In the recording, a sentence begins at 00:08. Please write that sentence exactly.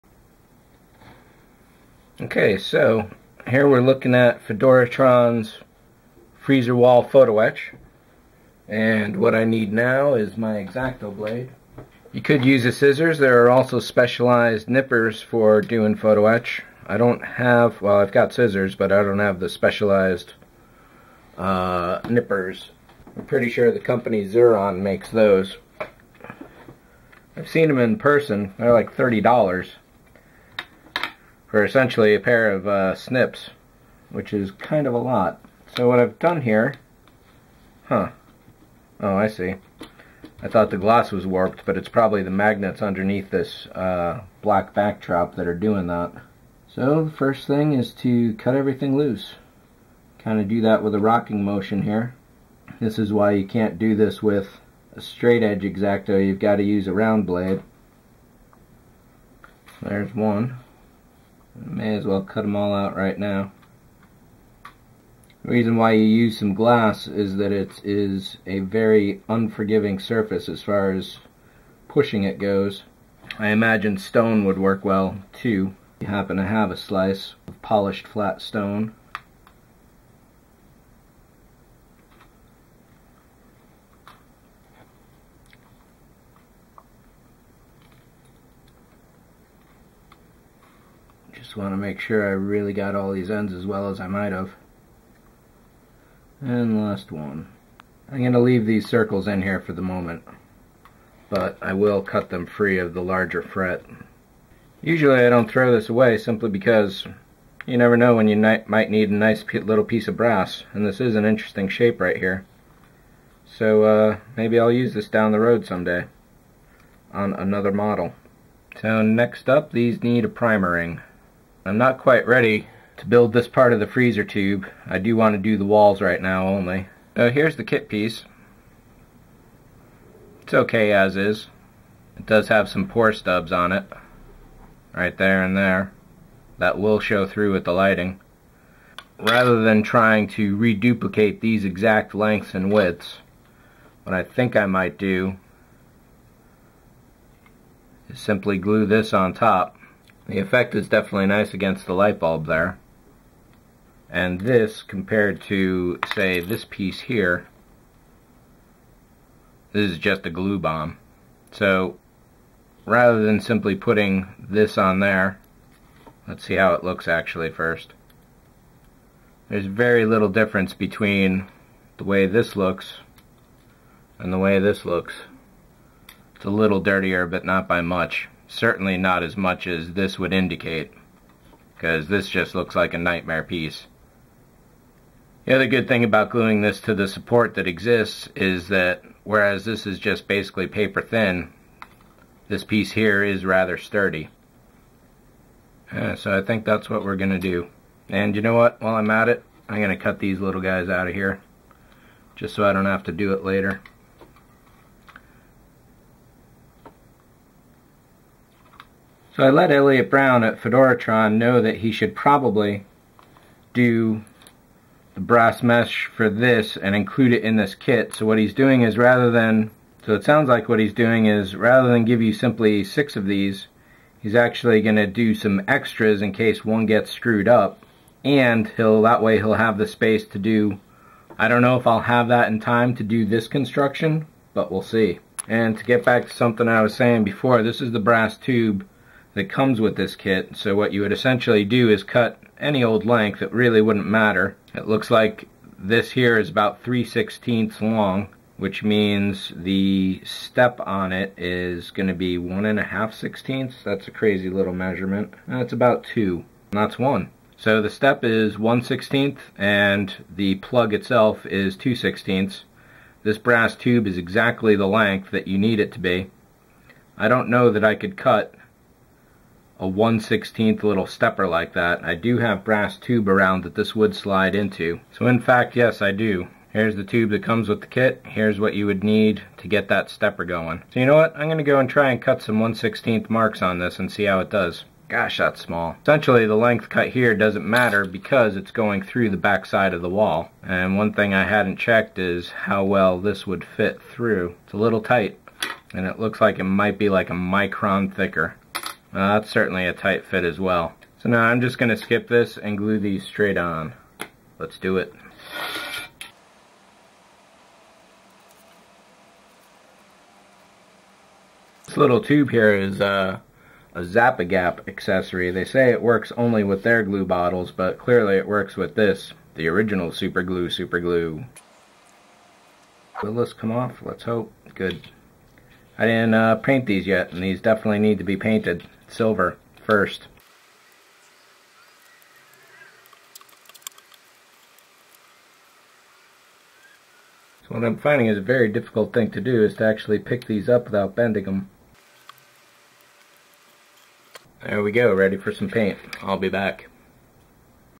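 And what I need now is my Exacto blade.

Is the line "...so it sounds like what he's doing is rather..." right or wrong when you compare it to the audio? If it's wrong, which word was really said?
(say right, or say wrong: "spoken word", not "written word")
right.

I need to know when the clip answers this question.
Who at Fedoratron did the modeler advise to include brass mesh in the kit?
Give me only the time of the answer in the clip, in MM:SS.
03:29.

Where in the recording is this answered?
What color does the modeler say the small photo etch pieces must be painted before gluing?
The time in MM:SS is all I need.
05:29.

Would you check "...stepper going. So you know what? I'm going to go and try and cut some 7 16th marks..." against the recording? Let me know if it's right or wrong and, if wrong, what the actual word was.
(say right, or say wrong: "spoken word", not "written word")
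wrong: "1", not "7".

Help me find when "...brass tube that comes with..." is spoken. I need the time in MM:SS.
03:58.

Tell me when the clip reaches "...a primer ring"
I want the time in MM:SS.
02:00.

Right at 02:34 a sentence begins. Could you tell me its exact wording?
And this, compared to, say, this piece here, this is just a glue bomb.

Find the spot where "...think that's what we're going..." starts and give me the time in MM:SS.
03:16.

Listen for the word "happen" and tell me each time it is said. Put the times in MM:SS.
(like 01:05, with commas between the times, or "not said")
01:16.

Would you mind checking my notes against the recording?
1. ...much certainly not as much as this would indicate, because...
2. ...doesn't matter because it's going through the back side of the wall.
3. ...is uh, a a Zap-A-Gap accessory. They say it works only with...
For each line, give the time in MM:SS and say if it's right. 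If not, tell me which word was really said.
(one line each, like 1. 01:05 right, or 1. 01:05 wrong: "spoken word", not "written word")
1. 02:57 right
2. 04:47 right
3. 05:12 right.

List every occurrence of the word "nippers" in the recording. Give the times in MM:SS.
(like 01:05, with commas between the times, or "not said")
00:14, 00:22.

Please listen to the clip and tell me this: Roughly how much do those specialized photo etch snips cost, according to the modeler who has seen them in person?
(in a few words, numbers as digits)
$30.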